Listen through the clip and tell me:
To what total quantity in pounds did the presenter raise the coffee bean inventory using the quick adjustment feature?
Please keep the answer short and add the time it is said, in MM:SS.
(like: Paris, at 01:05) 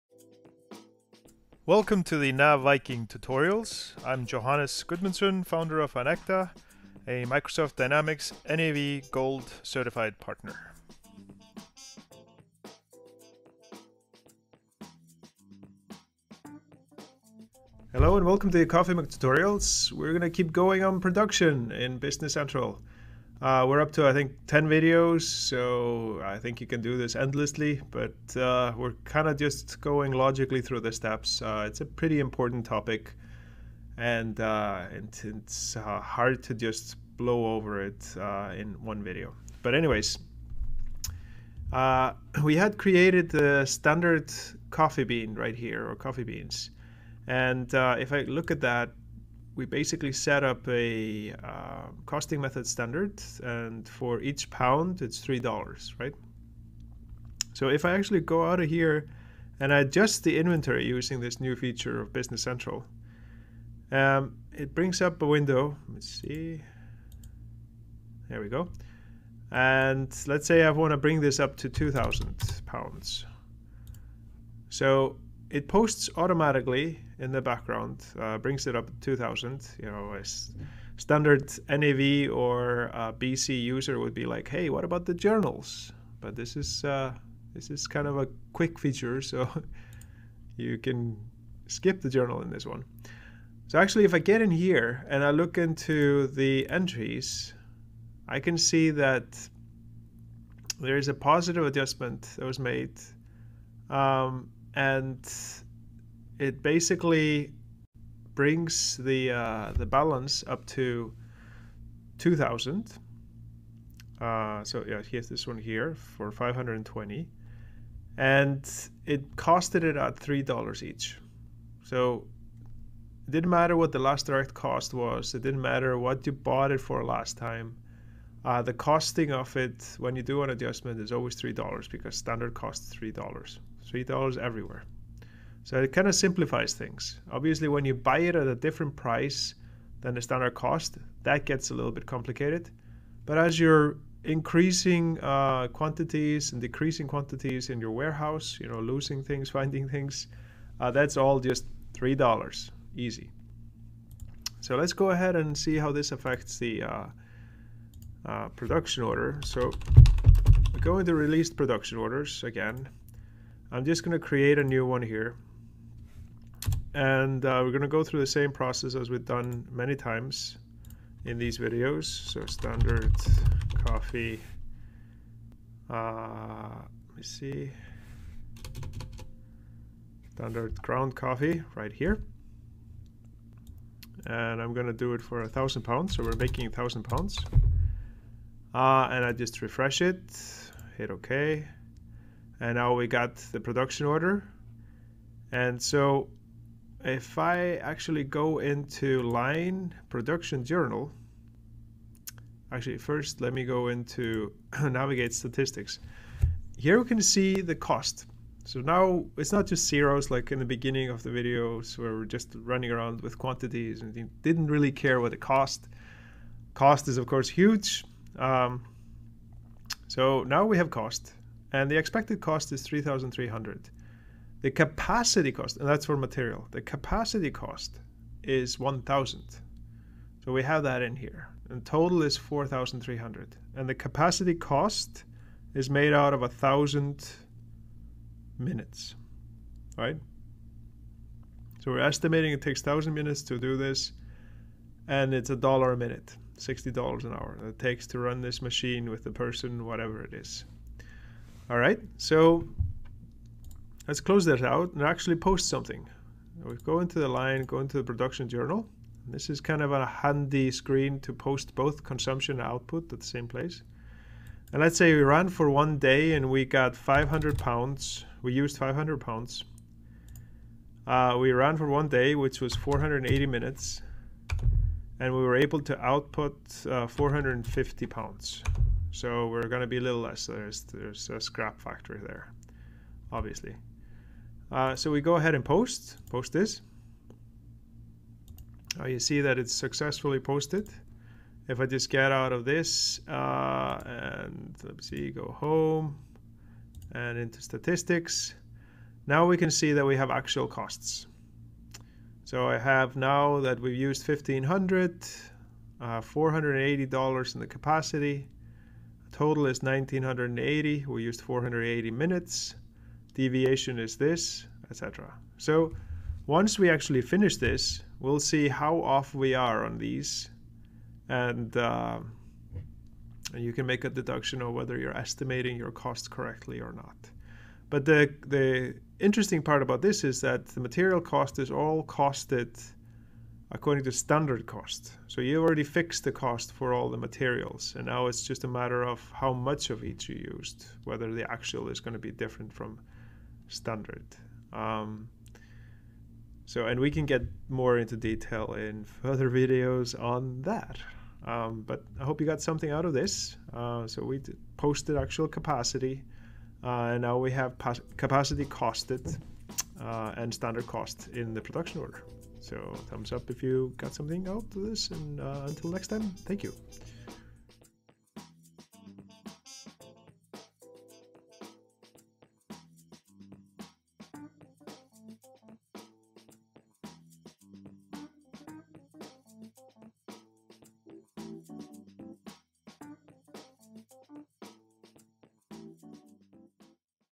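2,000, at 01:11.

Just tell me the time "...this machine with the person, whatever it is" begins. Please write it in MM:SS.
04:08.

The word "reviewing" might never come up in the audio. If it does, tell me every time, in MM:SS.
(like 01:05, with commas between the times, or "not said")
not said.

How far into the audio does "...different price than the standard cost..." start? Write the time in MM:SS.
02:18.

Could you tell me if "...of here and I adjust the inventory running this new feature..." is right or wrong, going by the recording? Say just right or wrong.
wrong.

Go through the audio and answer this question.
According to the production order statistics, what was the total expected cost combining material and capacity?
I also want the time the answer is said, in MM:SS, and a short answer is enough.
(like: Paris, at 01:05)
4,300, at 03:52.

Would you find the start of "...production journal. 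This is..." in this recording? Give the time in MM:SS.
04:18.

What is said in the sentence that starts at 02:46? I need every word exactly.
And uh, we're going to go through the same process as we've done many times in these videos.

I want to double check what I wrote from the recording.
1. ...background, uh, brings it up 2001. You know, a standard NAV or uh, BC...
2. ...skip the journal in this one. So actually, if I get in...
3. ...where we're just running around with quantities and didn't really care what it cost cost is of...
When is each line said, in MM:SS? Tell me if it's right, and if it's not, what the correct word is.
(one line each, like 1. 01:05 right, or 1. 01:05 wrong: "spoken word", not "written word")
1. 01:17 wrong: "2000", not "2001"
2. 01:31 right
3. 03:31 right.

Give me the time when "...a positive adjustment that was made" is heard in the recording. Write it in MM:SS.
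01:41.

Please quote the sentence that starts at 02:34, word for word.
So let's go ahead and see how this affects the uh, uh production order.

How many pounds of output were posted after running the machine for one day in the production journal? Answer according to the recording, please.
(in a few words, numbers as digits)
450.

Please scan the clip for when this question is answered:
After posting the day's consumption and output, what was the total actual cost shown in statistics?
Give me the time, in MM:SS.
05:09.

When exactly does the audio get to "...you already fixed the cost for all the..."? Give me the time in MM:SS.
05:35.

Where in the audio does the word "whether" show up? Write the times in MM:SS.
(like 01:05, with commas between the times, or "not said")
05:24, 05:41.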